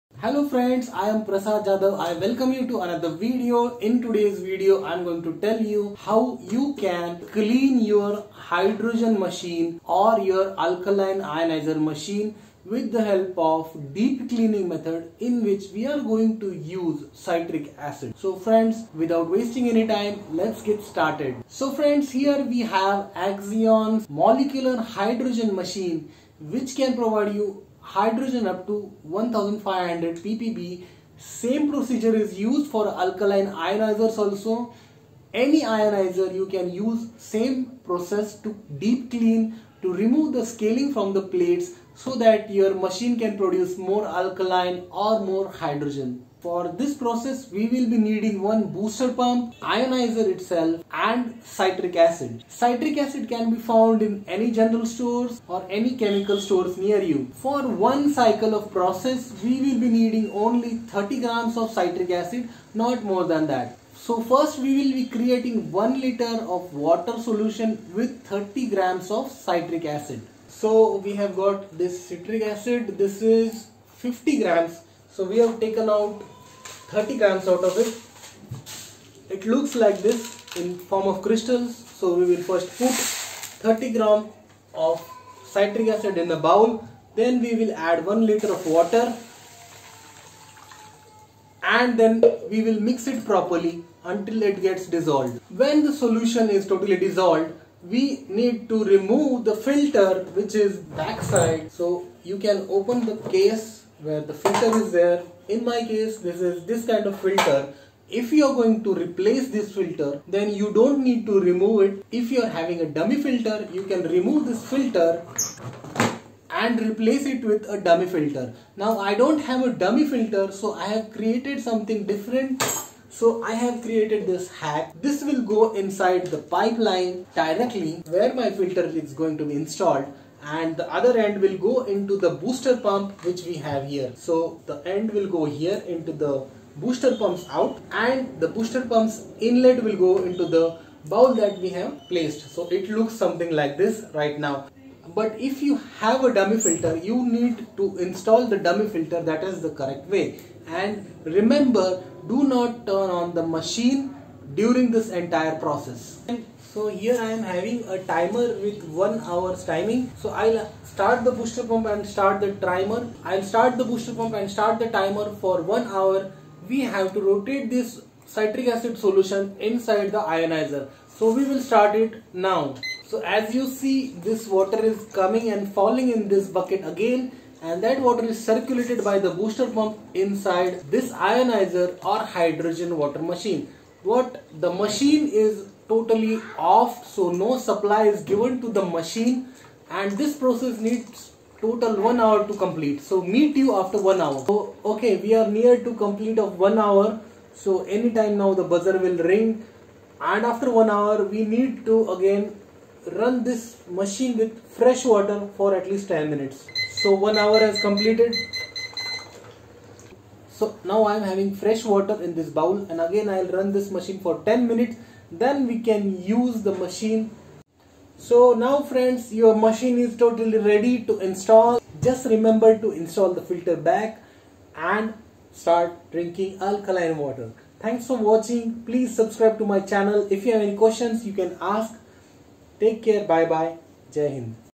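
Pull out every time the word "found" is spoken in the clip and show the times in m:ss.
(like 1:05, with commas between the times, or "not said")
0:53.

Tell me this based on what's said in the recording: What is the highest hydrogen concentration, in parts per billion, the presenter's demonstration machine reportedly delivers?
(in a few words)
1500 ppb.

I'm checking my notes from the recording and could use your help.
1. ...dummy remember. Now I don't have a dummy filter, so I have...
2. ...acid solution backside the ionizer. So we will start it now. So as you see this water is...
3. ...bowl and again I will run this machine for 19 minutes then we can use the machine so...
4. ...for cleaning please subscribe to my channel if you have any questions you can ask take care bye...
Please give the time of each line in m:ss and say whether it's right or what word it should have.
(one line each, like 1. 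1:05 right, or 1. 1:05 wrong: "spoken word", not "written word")
1. 1:57 wrong: "filter", not "remember"
2. 2:48 wrong: "inside", not "backside"
3. 3:32 wrong: "10", not "19"
4. 3:48 wrong: "watching", not "cleaning".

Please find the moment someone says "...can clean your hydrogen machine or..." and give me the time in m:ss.
0:06.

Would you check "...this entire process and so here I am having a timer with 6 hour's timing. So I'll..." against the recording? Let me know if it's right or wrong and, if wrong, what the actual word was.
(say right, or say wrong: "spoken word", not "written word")
wrong: "1", not "6".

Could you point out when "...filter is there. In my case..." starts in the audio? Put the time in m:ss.
1:44.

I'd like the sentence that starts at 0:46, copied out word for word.
For this process, we will be needing one booster pump, ionizer itself and citric acid.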